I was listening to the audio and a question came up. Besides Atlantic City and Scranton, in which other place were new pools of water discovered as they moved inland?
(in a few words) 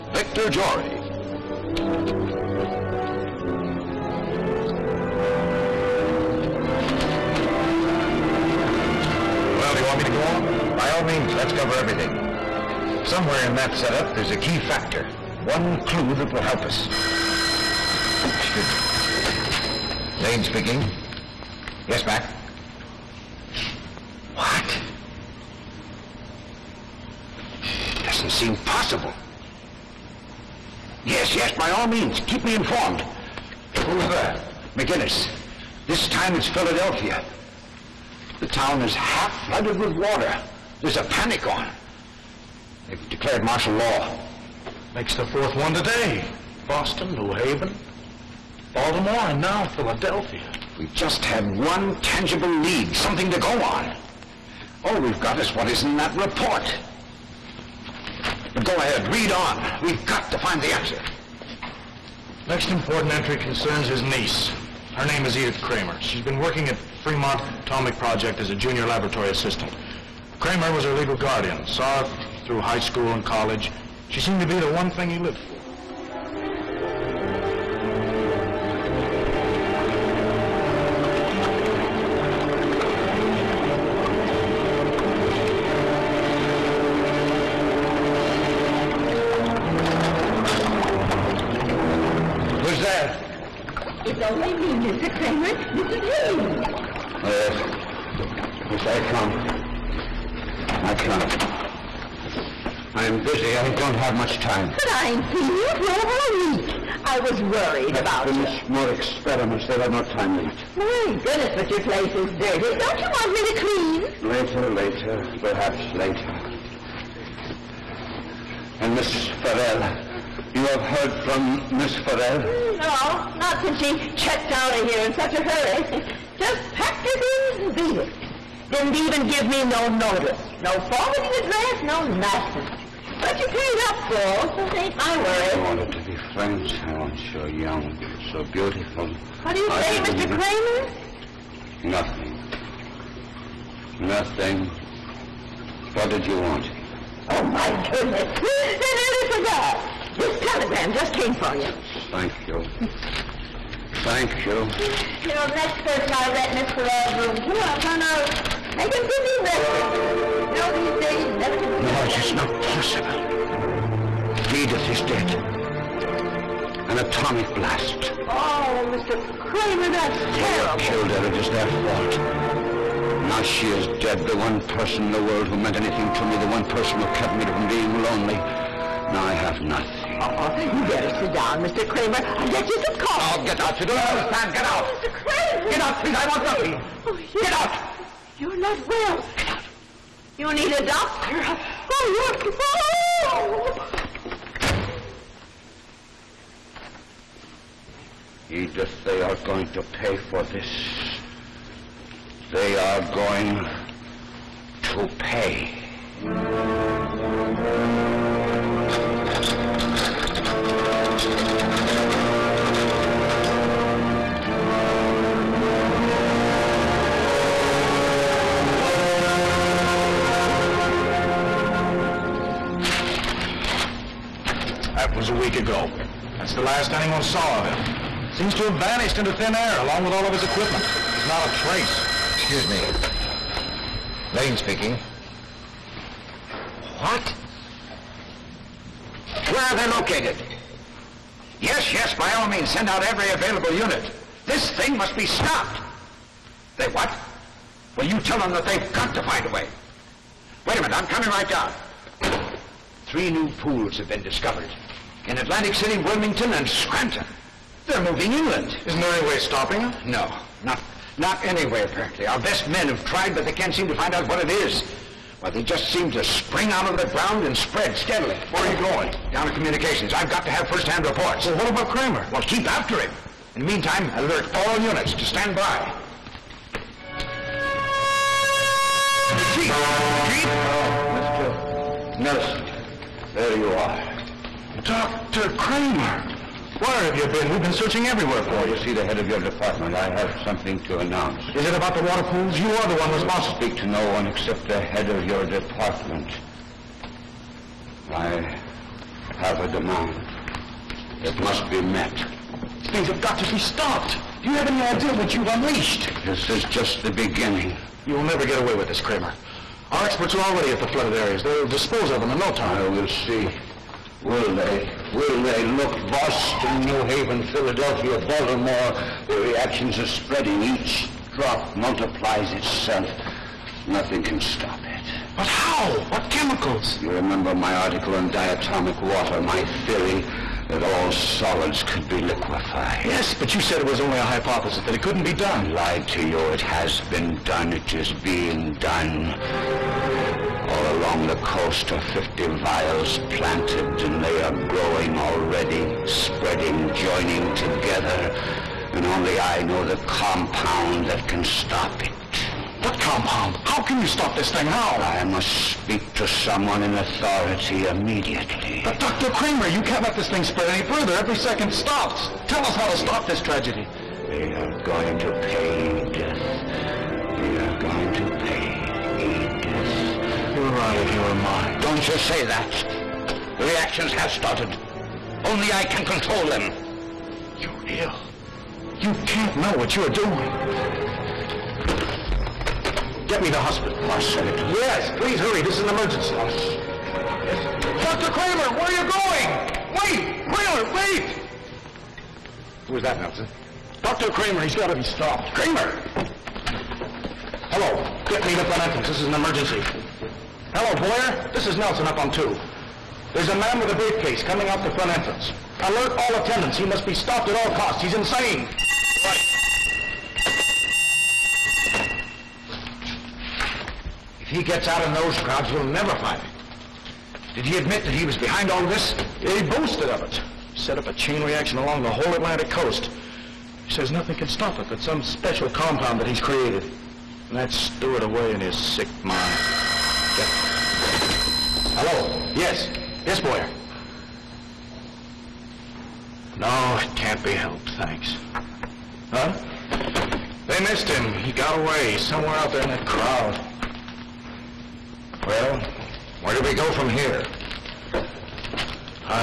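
Wilmington.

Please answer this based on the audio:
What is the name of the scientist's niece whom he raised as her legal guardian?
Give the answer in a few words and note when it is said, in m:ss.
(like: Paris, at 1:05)
Edith Kramer, at 1:05.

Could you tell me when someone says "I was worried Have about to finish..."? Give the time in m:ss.
1:47.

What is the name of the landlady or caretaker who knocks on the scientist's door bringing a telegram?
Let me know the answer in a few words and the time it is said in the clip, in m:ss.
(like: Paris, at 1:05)
Hayes, at 1:36.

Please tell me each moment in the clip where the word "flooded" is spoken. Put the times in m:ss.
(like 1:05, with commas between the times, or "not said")
0:39, 5:10.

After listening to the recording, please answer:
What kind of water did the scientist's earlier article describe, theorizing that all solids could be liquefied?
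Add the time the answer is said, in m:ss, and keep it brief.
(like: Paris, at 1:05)
diatomic water, at 5:28.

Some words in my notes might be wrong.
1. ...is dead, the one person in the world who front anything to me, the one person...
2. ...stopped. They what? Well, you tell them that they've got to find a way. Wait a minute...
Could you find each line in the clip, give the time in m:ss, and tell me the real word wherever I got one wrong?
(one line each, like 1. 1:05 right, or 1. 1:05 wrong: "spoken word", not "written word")
1. 2:53 wrong: "meant", not "front"
2. 4:05 right.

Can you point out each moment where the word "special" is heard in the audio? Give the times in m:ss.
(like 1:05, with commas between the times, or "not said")
7:05.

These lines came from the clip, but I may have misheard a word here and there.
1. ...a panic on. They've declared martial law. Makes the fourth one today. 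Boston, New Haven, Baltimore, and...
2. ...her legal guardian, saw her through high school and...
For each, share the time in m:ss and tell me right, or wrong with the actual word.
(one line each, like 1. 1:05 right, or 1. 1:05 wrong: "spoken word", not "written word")
1. 0:40 right
2. 1:10 right.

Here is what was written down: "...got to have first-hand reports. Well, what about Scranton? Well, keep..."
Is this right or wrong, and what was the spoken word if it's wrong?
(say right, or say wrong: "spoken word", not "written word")
wrong: "Kramer", not "Scranton".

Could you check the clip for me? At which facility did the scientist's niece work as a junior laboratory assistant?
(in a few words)
Fremont Atomic Project.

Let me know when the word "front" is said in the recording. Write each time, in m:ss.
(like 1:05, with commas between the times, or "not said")
6:38, 6:44.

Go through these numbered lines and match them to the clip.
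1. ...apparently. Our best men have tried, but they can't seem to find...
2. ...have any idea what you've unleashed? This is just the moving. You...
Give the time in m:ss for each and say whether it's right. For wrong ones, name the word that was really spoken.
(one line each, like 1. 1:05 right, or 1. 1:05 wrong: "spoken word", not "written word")
1. 4:21 right
2. 5:04 wrong: "beginning", not "moving".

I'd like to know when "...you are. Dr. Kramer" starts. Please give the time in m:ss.
4:43.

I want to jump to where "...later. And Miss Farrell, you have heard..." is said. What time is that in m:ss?
1:55.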